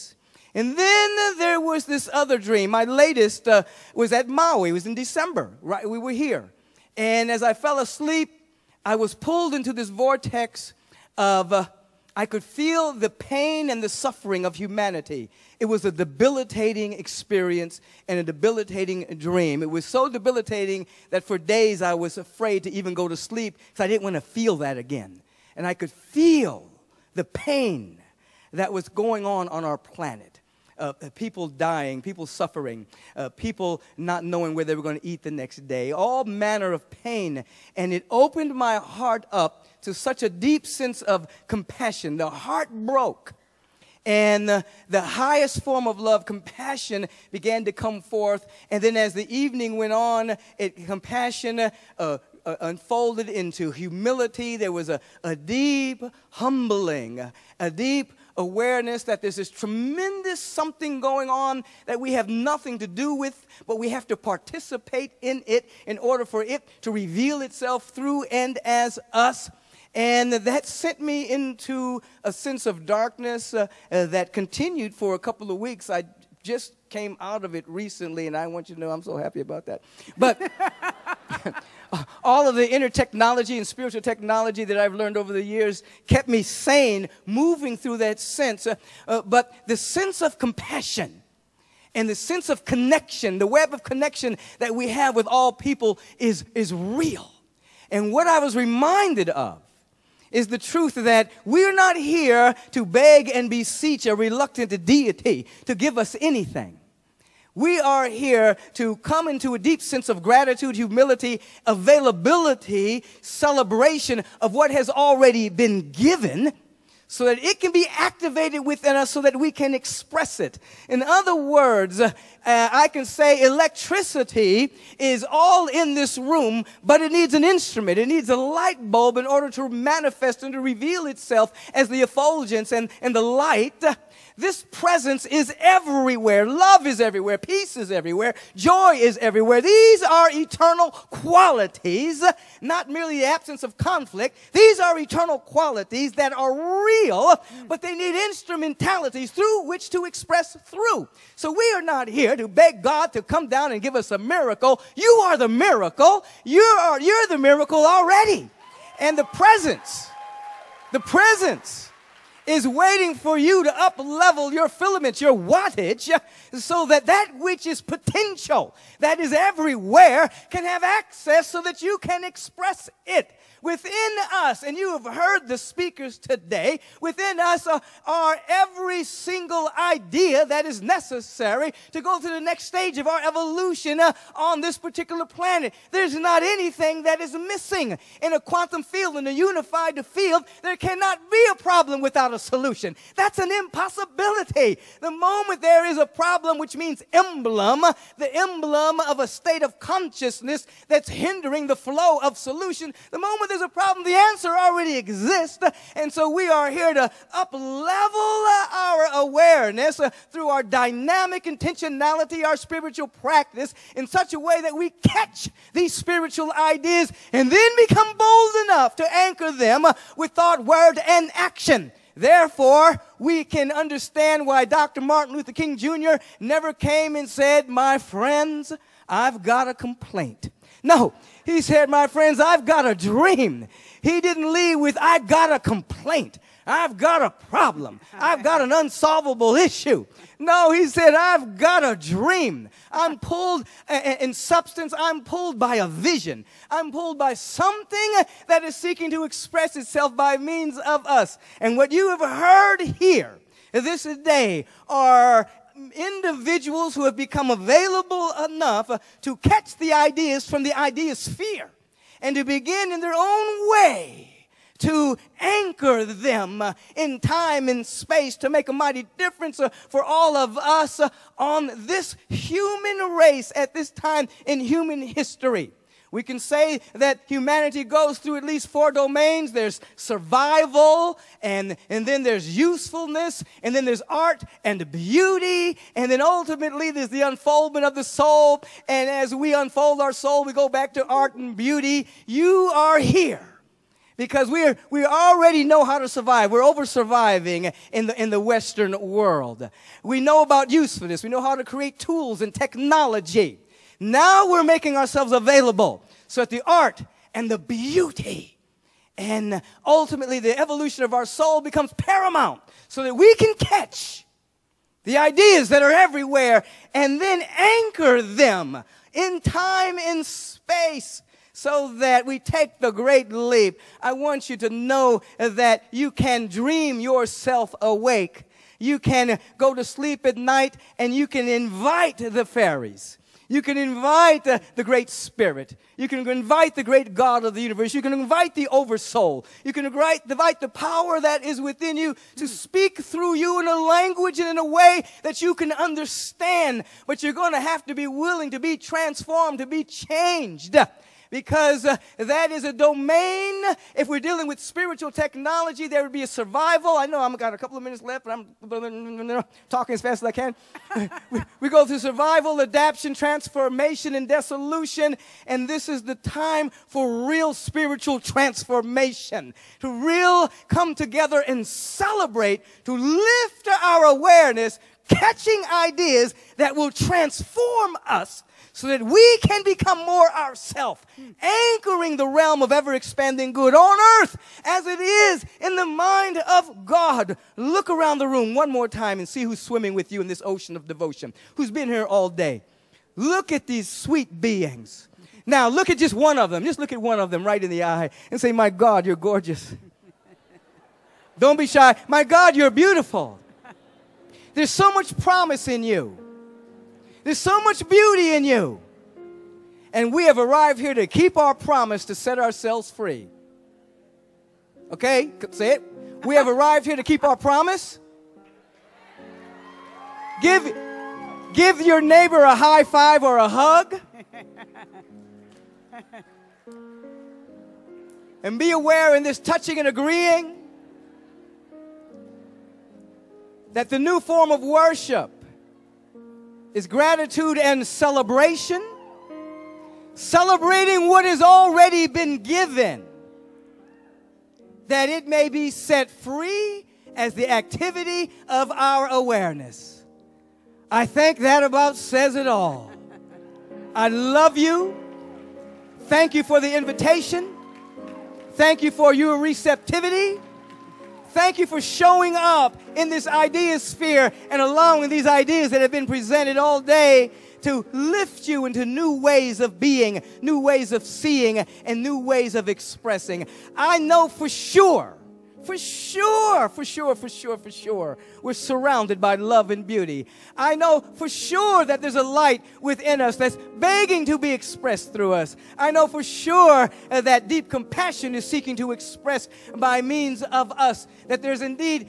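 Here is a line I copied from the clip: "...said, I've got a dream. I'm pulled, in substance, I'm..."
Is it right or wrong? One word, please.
right.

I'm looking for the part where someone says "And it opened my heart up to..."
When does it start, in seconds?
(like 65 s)
37 s.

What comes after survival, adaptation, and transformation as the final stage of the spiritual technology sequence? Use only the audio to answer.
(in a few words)
dissolution.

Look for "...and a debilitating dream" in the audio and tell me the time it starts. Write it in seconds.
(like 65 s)
18 s.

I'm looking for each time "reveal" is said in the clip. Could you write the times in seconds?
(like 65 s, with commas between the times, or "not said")
66 s, 130 s.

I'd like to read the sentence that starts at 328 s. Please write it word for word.
You can go to sleep at night and you can invite the fairies.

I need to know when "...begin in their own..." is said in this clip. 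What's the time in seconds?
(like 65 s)
262 s.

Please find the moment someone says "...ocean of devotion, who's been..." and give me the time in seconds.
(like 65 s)
390 s.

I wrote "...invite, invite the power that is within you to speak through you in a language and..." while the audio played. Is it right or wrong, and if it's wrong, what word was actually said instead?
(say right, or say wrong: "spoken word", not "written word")
right.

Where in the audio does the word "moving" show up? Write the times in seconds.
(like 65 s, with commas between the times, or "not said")
87 s.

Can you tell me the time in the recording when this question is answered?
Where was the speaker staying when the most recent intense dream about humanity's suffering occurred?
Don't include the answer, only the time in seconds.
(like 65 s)
4 s.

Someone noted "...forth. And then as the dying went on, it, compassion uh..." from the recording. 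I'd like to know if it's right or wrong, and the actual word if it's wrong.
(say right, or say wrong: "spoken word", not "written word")
wrong: "evening", not "dying".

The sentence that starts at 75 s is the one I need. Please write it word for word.
I just came out of it recently, and I want you to know I'm so happy about that.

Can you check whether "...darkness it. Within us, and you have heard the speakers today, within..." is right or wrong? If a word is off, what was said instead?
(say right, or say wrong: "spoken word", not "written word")
wrong: "express", not "darkness".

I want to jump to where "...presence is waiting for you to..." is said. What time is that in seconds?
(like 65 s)
160 s.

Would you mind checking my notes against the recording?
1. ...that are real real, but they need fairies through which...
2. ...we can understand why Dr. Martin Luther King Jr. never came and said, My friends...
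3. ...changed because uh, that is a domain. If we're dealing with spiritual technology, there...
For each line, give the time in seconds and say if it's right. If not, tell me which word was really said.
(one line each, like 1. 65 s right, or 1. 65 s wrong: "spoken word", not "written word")
1. 146 s wrong: "instrumentalities", not "fairies"
2. 223 s right
3. 349 s right.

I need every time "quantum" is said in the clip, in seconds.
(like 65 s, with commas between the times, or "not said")
188 s.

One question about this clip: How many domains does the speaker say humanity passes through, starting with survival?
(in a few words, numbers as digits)
4.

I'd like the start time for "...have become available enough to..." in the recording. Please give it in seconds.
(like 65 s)
257 s.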